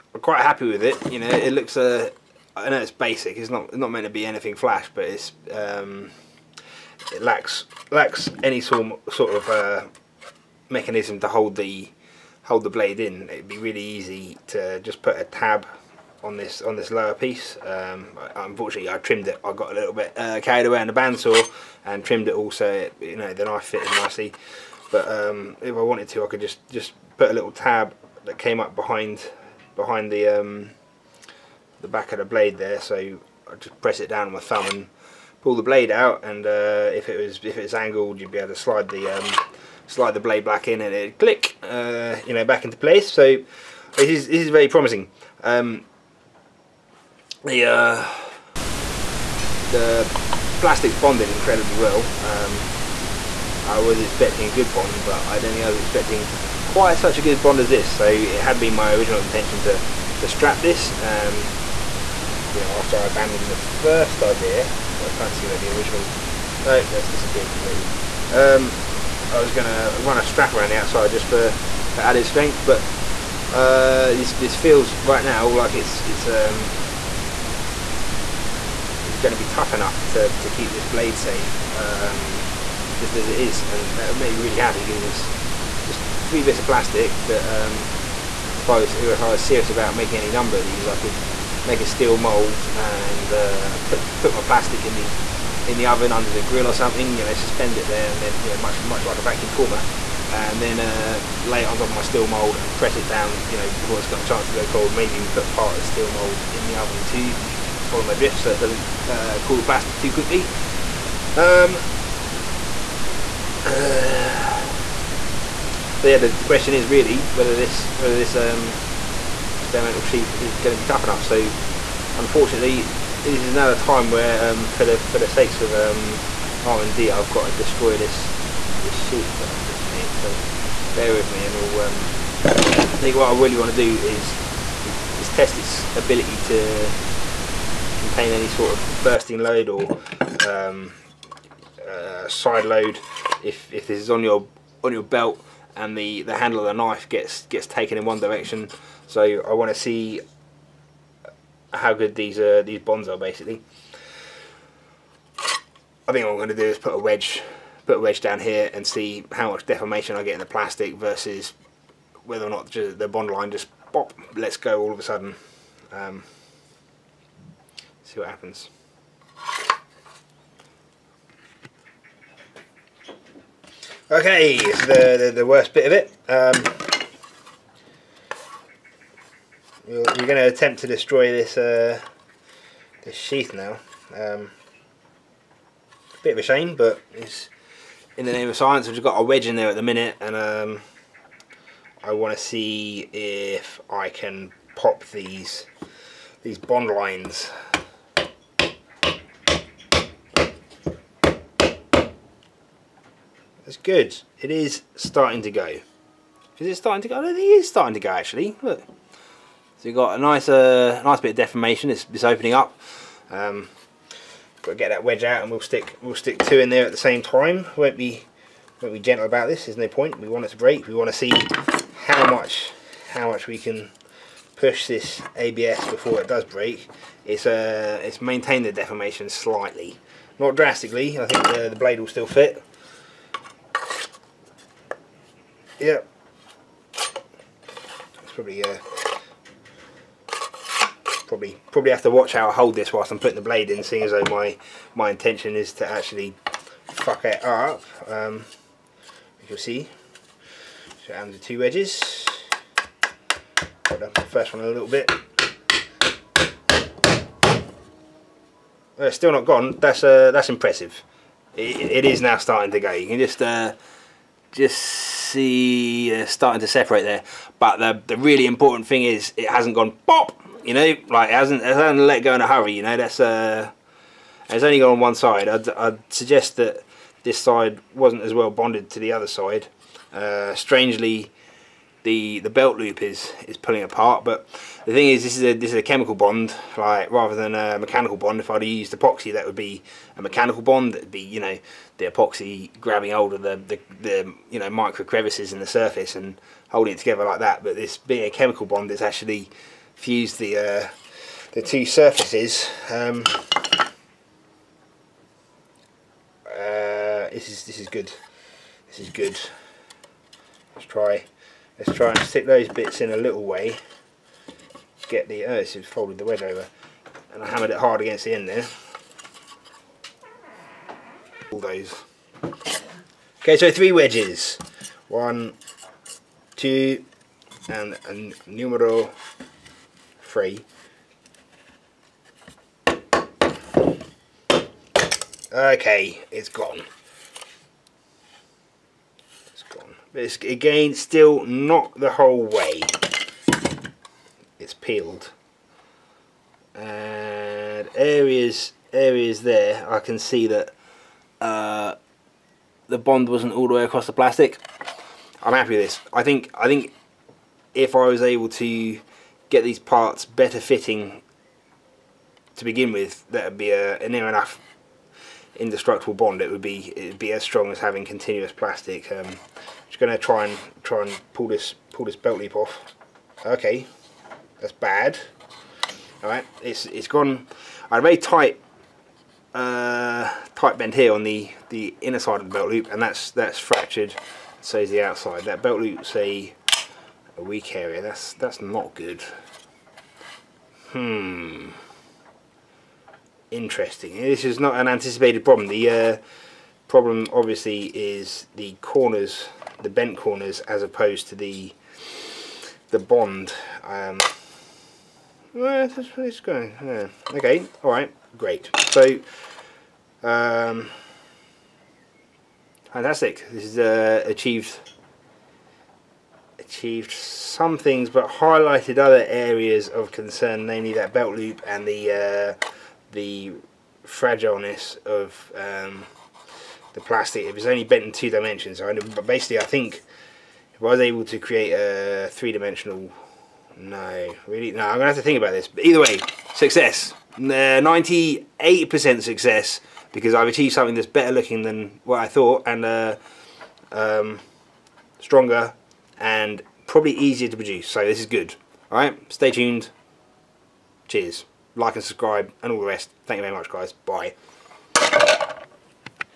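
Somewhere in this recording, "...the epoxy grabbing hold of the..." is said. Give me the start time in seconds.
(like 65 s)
291 s.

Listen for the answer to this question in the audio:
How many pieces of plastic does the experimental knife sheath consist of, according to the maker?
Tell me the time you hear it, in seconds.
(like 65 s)
86 s.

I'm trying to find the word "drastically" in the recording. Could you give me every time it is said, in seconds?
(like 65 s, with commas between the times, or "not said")
230 s.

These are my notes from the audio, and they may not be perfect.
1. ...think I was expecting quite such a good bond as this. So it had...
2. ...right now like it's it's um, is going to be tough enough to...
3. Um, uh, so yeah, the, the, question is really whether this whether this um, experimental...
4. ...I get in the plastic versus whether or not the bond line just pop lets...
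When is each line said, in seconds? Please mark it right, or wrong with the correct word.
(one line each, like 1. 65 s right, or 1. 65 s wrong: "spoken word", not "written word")
1. 55 s right
2. 75 s right
3. 111 s right
4. 160 s right.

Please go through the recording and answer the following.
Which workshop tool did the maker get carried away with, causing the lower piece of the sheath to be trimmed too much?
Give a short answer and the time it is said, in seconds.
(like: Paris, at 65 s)
bandsaw, at 20 s.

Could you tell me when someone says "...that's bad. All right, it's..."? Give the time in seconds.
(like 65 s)
374 s.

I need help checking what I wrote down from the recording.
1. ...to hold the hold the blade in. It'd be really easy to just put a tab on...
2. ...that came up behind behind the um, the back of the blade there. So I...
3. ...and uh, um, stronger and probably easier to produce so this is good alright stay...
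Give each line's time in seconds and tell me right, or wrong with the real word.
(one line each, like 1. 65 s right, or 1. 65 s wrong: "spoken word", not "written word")
1. 11 s right
2. 28 s right
3. 442 s right.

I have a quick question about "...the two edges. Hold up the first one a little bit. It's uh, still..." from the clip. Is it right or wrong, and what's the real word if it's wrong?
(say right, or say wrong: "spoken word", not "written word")
right.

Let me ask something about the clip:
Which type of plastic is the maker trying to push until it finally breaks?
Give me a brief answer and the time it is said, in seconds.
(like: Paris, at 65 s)
ABS, at 225 s.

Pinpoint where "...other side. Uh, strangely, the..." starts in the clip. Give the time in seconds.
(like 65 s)
279 s.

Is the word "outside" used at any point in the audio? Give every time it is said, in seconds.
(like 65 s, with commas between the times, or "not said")
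70 s, 385 s.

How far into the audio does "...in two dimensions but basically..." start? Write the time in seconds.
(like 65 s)
428 s.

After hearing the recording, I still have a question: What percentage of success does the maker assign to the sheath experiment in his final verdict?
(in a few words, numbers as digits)
98%.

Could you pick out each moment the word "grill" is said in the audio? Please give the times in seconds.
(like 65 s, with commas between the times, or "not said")
96 s.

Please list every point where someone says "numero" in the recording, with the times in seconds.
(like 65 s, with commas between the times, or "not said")
328 s.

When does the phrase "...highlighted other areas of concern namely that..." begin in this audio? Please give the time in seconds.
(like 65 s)
418 s.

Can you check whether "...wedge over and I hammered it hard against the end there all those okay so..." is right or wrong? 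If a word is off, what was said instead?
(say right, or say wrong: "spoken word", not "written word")
right.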